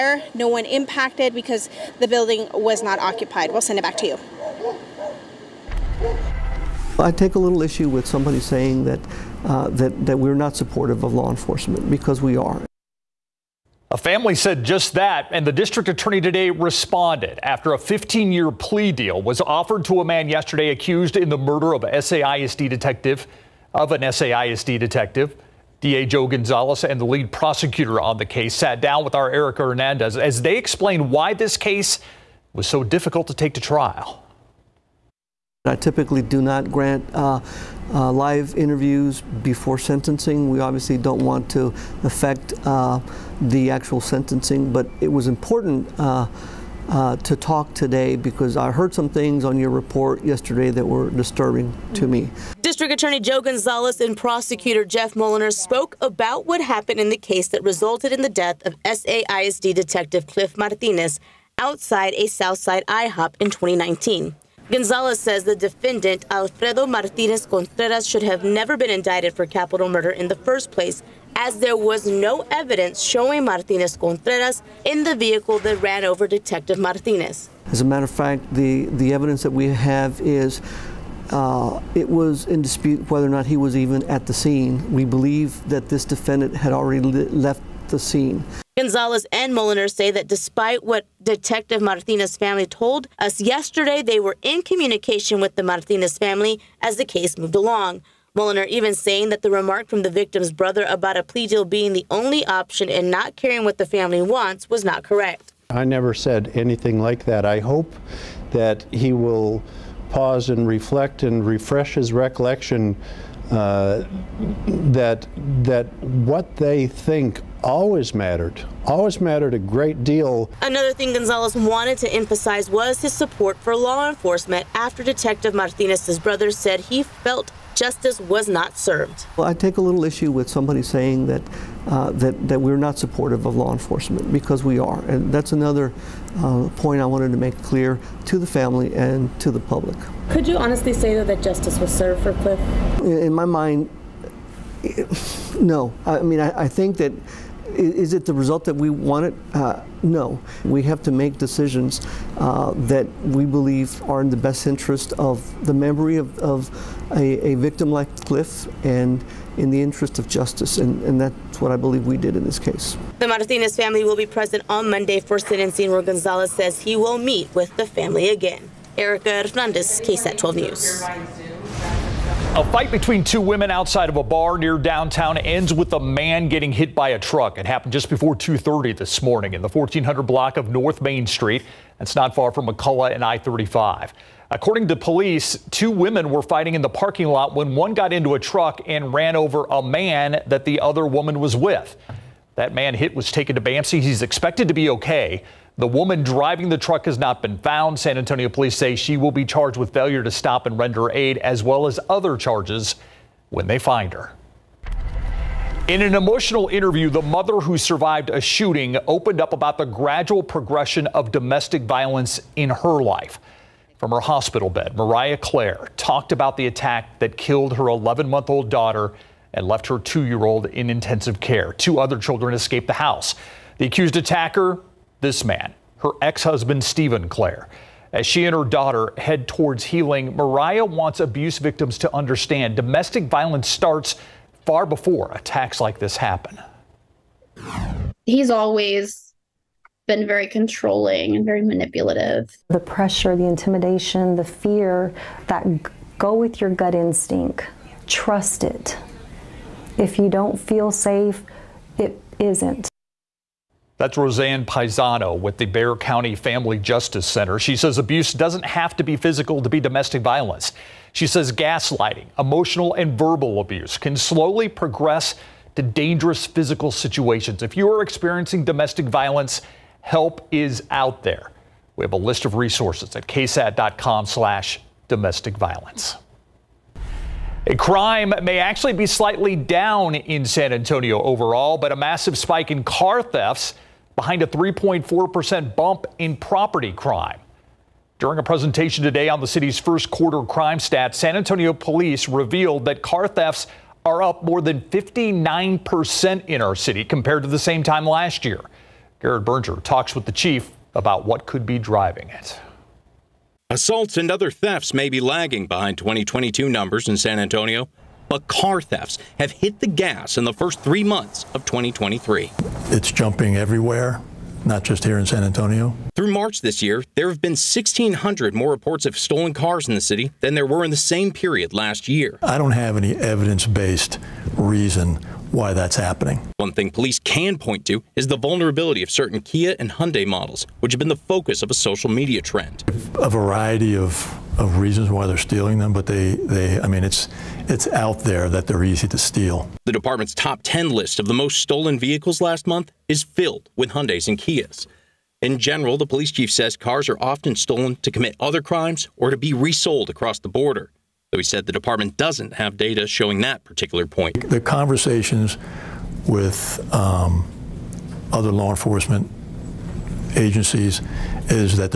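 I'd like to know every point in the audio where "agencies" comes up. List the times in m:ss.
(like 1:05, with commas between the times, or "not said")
6:00.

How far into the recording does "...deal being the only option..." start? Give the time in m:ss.
1:41.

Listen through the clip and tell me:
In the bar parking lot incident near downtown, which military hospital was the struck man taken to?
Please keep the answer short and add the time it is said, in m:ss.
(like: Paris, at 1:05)
BAMC, at 3:13.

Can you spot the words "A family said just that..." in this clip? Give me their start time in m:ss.
0:13.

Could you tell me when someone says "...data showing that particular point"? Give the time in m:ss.
5:52.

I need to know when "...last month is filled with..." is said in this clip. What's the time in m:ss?
5:42.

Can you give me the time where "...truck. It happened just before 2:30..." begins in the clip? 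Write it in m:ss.
2:57.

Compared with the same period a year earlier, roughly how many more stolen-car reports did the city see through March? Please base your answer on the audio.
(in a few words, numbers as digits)
1,600.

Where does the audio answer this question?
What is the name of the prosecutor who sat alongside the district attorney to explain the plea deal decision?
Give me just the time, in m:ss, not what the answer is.
0:54.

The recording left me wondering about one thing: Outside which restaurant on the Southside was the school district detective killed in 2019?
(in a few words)
IHOP.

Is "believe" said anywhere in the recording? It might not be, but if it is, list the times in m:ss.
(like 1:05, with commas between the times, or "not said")
1:25, 2:33, 2:41.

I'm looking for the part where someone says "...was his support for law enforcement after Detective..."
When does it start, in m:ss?
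2:02.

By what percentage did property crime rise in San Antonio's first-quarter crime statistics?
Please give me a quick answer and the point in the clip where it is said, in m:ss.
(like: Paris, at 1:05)
3.4%, at 4:44.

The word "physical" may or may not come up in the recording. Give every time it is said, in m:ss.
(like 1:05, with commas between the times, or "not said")
4:19, 4:26.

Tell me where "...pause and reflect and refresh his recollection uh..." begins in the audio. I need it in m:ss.
1:50.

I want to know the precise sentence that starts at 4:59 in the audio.
Garrett Berger talks with the chief about what could be driving it.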